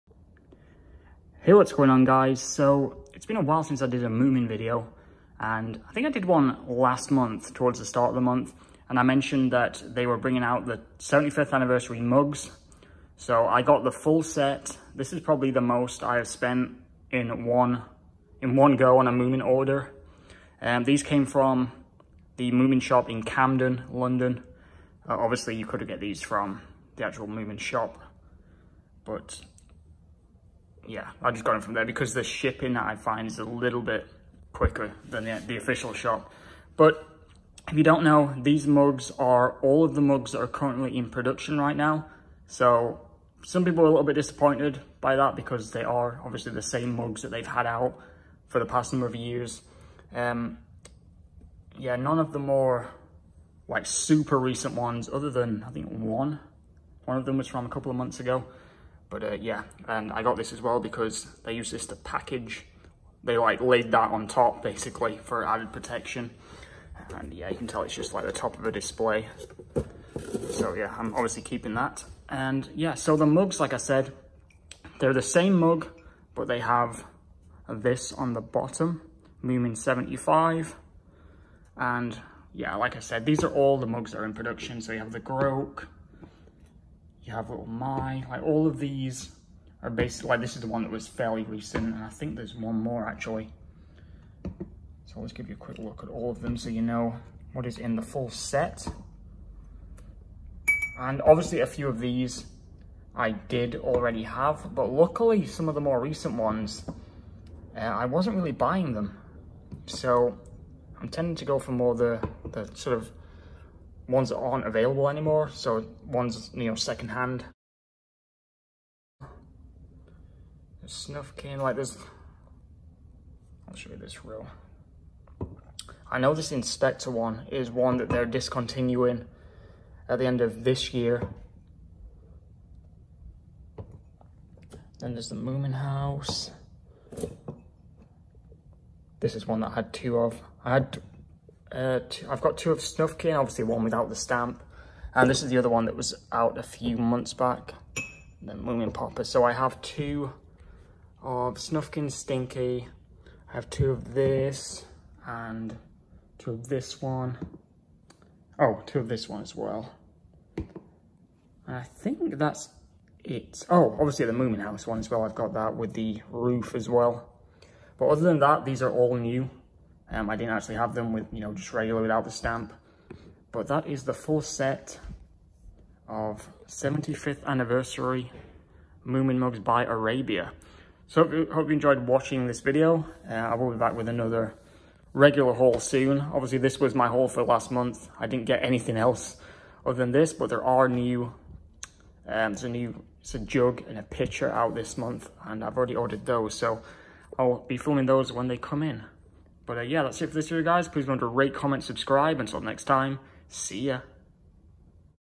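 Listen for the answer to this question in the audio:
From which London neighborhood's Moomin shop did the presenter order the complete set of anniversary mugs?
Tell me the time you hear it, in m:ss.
0:23.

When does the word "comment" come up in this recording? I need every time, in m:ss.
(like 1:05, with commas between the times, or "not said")
3:21.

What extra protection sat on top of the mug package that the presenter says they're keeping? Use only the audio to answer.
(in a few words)
The top of a display.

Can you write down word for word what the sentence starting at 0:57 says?
One of them was from a couple of months ago.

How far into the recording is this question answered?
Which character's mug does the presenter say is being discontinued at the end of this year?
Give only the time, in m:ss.
2:06.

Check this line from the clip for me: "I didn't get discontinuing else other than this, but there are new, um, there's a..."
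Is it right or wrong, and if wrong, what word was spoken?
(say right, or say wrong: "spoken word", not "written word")
wrong: "anything", not "discontinuing".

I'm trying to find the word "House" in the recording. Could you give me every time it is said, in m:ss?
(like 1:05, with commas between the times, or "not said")
2:15, 2:44.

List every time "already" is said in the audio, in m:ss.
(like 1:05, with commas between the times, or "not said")
1:43, 3:15.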